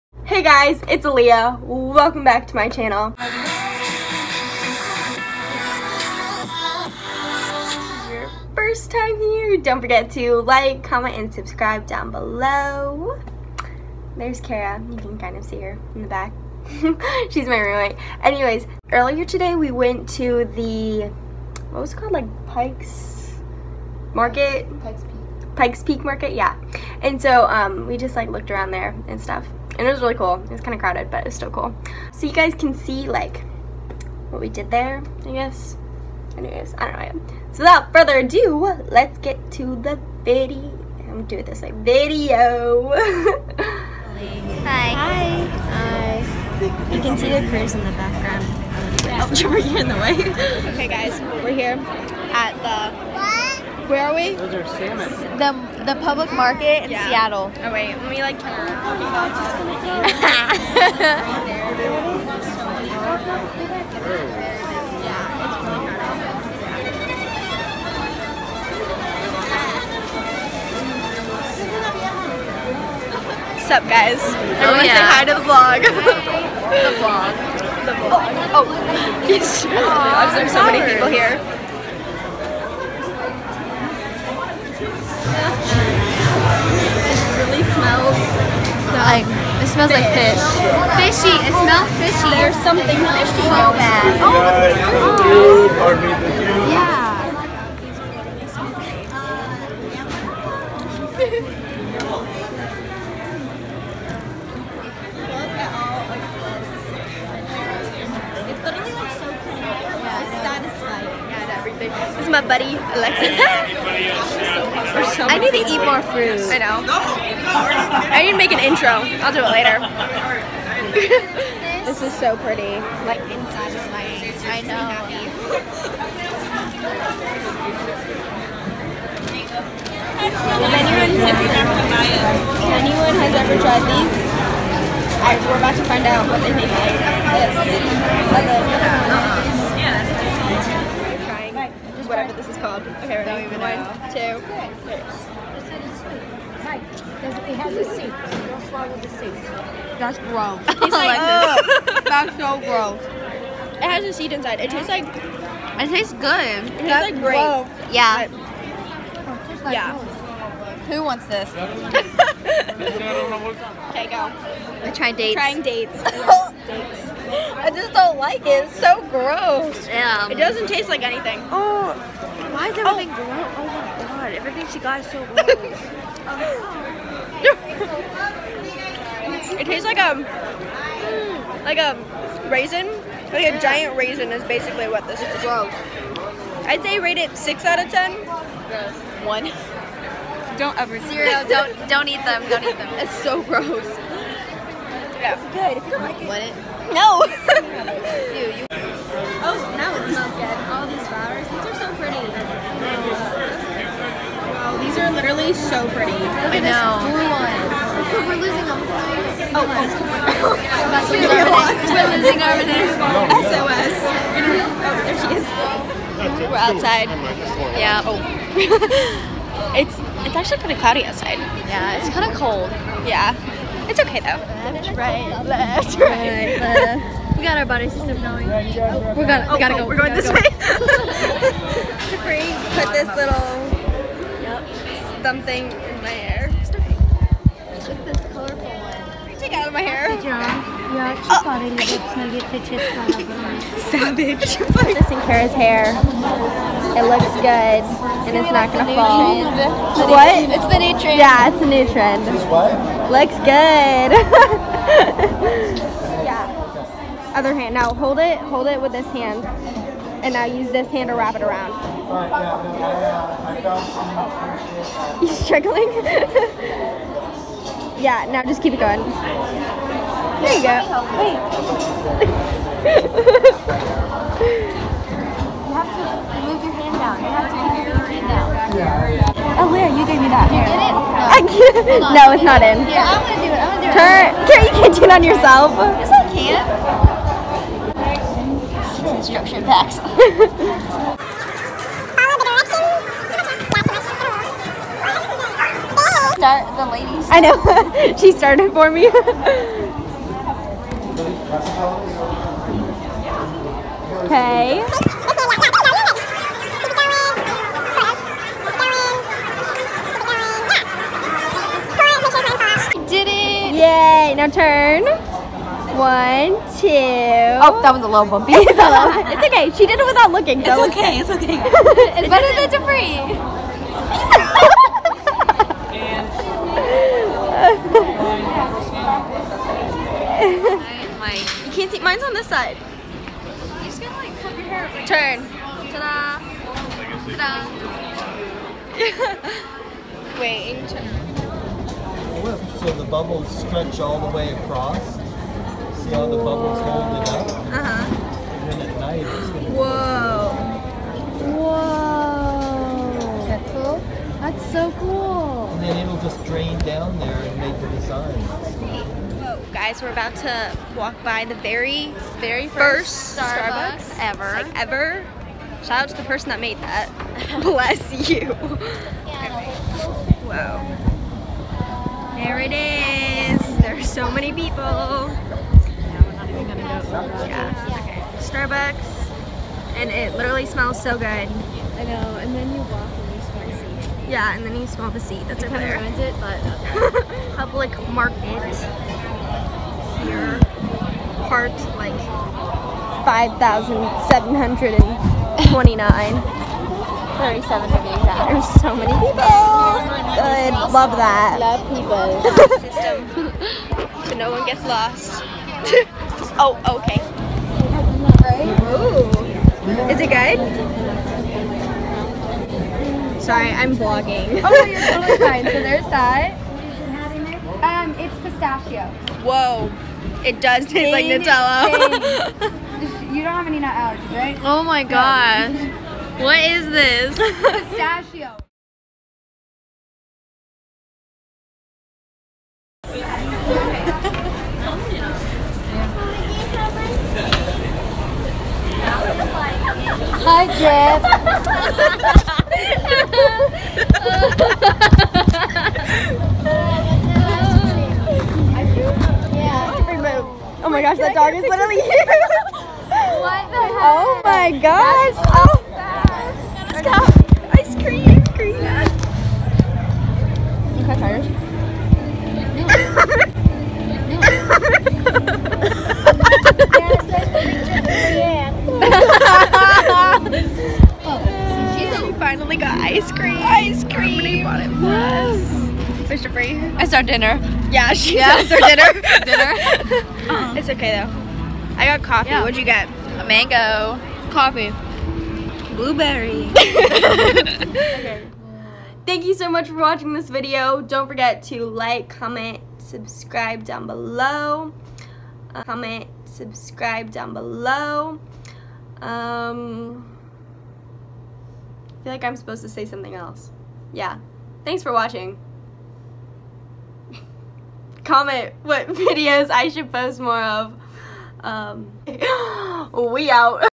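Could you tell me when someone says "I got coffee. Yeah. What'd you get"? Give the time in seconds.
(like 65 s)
482 s.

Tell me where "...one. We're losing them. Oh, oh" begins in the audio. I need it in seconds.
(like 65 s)
207 s.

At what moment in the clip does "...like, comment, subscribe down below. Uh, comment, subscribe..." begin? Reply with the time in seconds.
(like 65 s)
491 s.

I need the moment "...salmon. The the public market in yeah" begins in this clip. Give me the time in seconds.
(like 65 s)
54 s.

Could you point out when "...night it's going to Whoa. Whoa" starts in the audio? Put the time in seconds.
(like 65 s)
348 s.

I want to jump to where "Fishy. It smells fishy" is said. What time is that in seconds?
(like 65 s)
90 s.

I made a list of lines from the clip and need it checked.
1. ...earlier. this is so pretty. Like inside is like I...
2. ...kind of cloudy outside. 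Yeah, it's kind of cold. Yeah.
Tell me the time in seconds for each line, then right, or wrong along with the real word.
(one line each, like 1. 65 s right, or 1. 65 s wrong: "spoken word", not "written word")
1. 119 s wrong: "later", not "earlier"
2. 220 s right.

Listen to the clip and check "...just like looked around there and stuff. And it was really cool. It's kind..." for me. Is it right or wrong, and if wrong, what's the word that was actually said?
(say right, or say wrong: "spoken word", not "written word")
right.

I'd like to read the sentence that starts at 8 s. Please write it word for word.
first time here, don't forget to like, comment, and subscribe down below.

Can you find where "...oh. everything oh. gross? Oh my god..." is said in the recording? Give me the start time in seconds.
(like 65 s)
172 s.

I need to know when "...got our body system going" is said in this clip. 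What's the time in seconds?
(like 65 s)
227 s.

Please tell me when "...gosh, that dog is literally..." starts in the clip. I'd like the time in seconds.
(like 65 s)
451 s.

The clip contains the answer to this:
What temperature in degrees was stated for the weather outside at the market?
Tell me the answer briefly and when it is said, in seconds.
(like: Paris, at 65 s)
37 degrees, at 397 s.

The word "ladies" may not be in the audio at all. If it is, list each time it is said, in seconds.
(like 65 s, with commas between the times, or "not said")
296 s.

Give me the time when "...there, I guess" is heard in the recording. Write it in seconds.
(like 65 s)
34 s.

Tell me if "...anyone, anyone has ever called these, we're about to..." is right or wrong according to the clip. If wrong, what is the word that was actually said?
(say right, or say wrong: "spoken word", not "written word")
wrong: "tried", not "called".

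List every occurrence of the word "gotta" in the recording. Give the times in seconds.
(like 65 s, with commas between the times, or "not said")
229 s, 334 s.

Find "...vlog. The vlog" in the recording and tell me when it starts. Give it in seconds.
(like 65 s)
76 s.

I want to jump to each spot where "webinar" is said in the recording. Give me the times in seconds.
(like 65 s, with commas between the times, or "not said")
not said.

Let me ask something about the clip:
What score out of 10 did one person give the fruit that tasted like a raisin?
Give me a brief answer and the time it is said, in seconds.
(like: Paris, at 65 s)
6, at 187 s.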